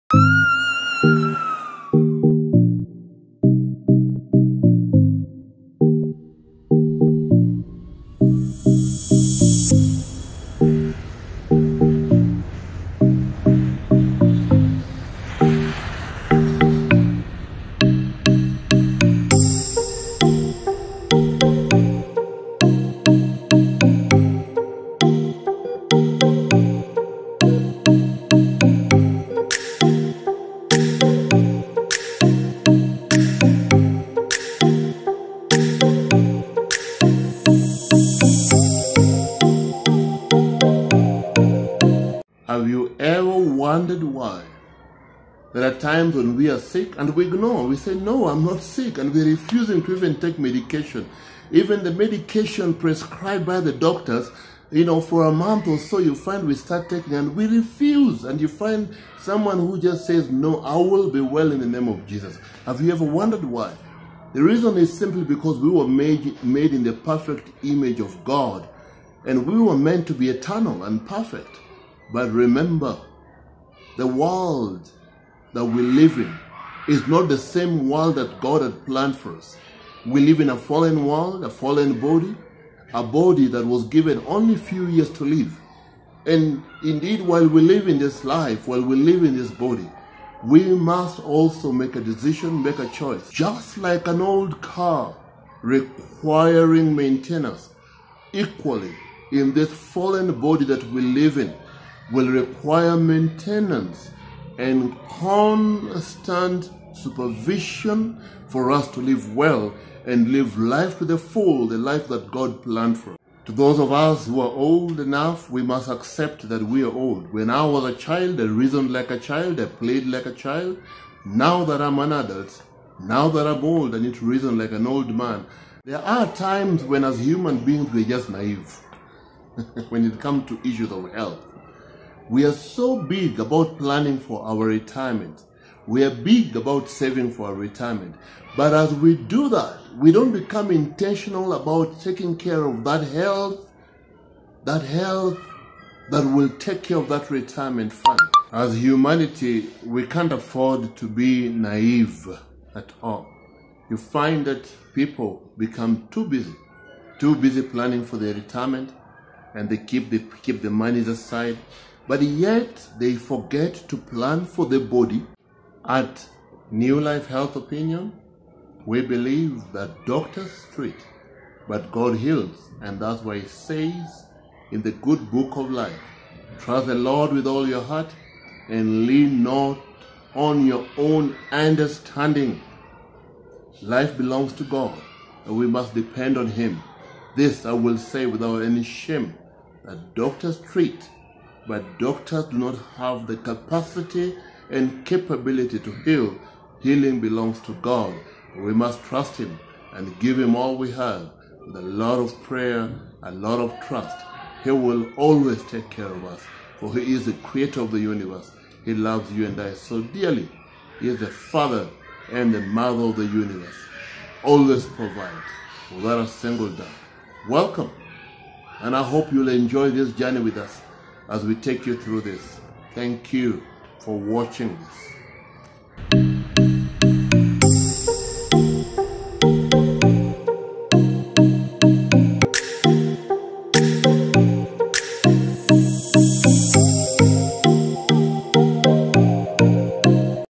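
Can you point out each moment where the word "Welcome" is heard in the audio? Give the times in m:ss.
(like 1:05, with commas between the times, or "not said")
3:37.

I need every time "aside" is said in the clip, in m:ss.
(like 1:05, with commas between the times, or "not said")
2:41.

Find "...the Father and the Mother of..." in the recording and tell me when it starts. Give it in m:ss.
3:31.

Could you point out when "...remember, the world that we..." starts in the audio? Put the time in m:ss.
1:12.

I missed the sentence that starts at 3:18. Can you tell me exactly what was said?
We must trust Him and give Him all we have with a lot of prayer, a lot of trust.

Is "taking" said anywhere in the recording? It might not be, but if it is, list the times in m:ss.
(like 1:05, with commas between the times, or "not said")
0:56, 2:21.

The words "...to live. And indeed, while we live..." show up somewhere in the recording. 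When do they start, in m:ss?
1:25.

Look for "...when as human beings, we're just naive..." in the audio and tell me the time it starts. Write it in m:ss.
2:06.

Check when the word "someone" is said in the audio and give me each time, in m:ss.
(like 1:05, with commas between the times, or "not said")
0:59.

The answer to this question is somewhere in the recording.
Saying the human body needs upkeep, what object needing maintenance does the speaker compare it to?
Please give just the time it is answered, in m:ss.
1:34.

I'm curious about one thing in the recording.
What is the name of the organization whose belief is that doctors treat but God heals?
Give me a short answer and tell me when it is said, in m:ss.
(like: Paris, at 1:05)
New Life Health Opinion, at 2:46.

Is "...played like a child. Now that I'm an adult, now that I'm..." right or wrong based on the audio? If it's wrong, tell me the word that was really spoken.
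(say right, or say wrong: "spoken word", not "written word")
right.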